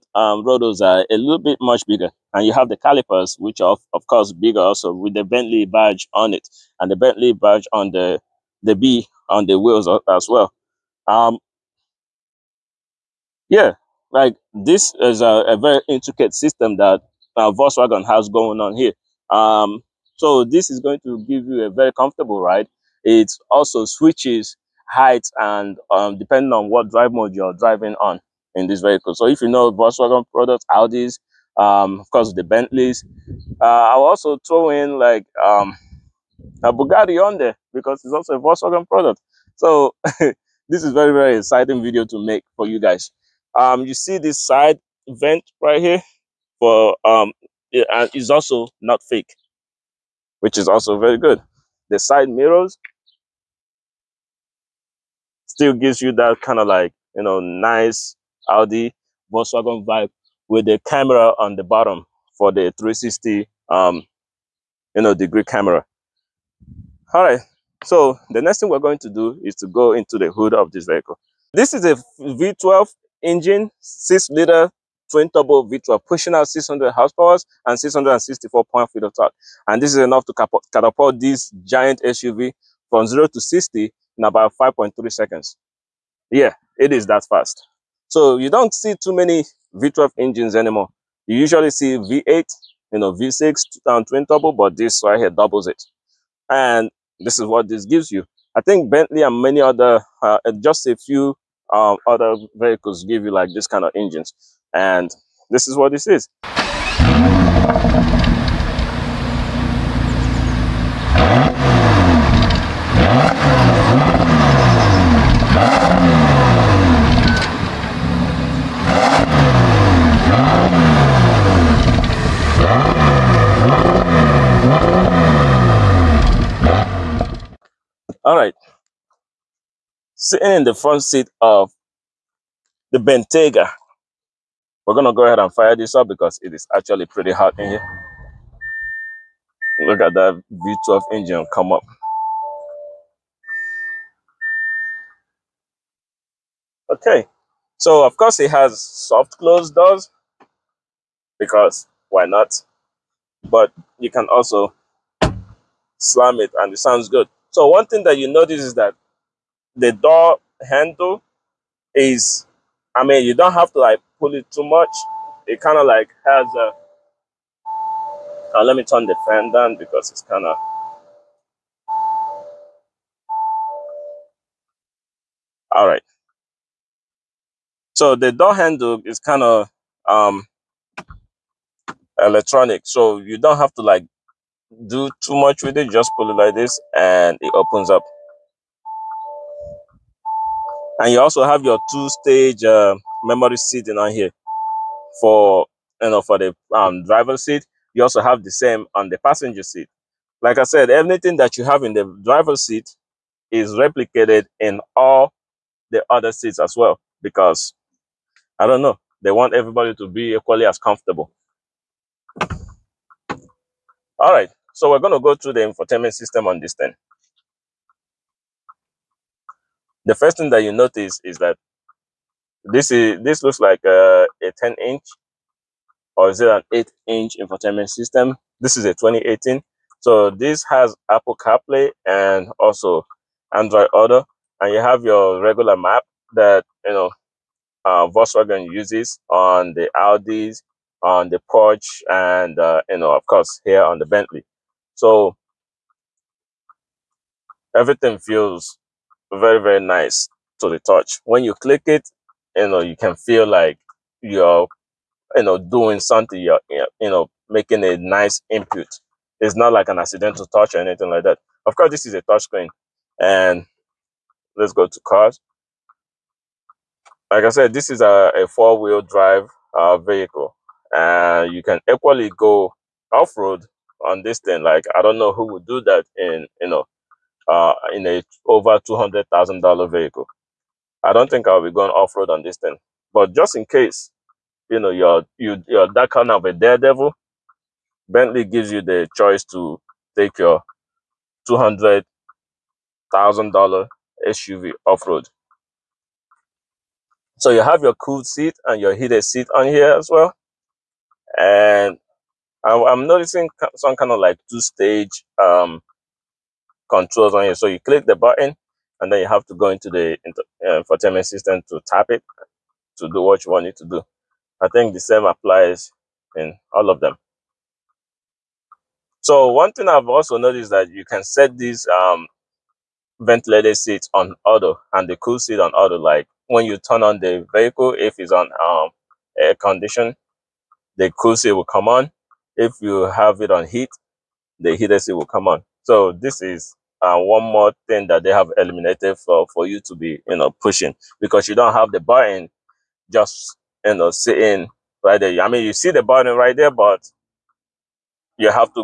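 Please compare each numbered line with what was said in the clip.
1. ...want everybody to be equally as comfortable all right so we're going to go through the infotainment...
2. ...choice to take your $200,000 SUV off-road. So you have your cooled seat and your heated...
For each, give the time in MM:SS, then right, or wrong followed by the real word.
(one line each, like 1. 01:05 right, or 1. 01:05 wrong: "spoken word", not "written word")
1. 03:29 right
2. 04:49 right.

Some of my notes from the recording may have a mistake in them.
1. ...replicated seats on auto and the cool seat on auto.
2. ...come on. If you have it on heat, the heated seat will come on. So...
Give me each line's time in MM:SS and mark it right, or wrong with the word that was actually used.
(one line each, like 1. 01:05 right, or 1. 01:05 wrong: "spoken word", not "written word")
1. 05:23 wrong: "ventilated", not "replicated"
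2. 05:31 right.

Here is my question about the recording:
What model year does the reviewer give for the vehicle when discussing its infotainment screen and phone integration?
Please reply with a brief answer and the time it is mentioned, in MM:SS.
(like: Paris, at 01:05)
2018, at 03:48.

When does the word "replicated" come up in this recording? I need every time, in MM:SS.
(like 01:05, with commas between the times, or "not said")
03:23.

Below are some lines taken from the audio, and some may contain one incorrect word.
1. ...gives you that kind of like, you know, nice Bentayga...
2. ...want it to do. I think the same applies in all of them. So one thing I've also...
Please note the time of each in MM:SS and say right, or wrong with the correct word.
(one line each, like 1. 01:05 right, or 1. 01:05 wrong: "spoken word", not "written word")
1. 00:55 wrong: "Audi", not "Bentayga"
2. 05:13 right.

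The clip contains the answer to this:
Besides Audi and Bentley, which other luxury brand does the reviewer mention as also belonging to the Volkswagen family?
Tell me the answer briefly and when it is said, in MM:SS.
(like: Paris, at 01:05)
Bugatti, at 00:36.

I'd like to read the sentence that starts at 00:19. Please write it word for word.
Um, so this is going to give you a very comfortable ride.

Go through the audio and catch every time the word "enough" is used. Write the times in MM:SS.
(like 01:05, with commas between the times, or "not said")
01:19.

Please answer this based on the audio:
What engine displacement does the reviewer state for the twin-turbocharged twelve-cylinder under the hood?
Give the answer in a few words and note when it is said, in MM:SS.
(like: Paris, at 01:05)
6-liter, at 01:13.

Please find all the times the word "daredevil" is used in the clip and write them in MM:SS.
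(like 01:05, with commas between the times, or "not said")
04:46.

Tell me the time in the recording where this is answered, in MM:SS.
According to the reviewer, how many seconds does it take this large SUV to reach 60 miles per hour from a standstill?
01:24.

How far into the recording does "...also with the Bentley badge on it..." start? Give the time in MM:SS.
00:04.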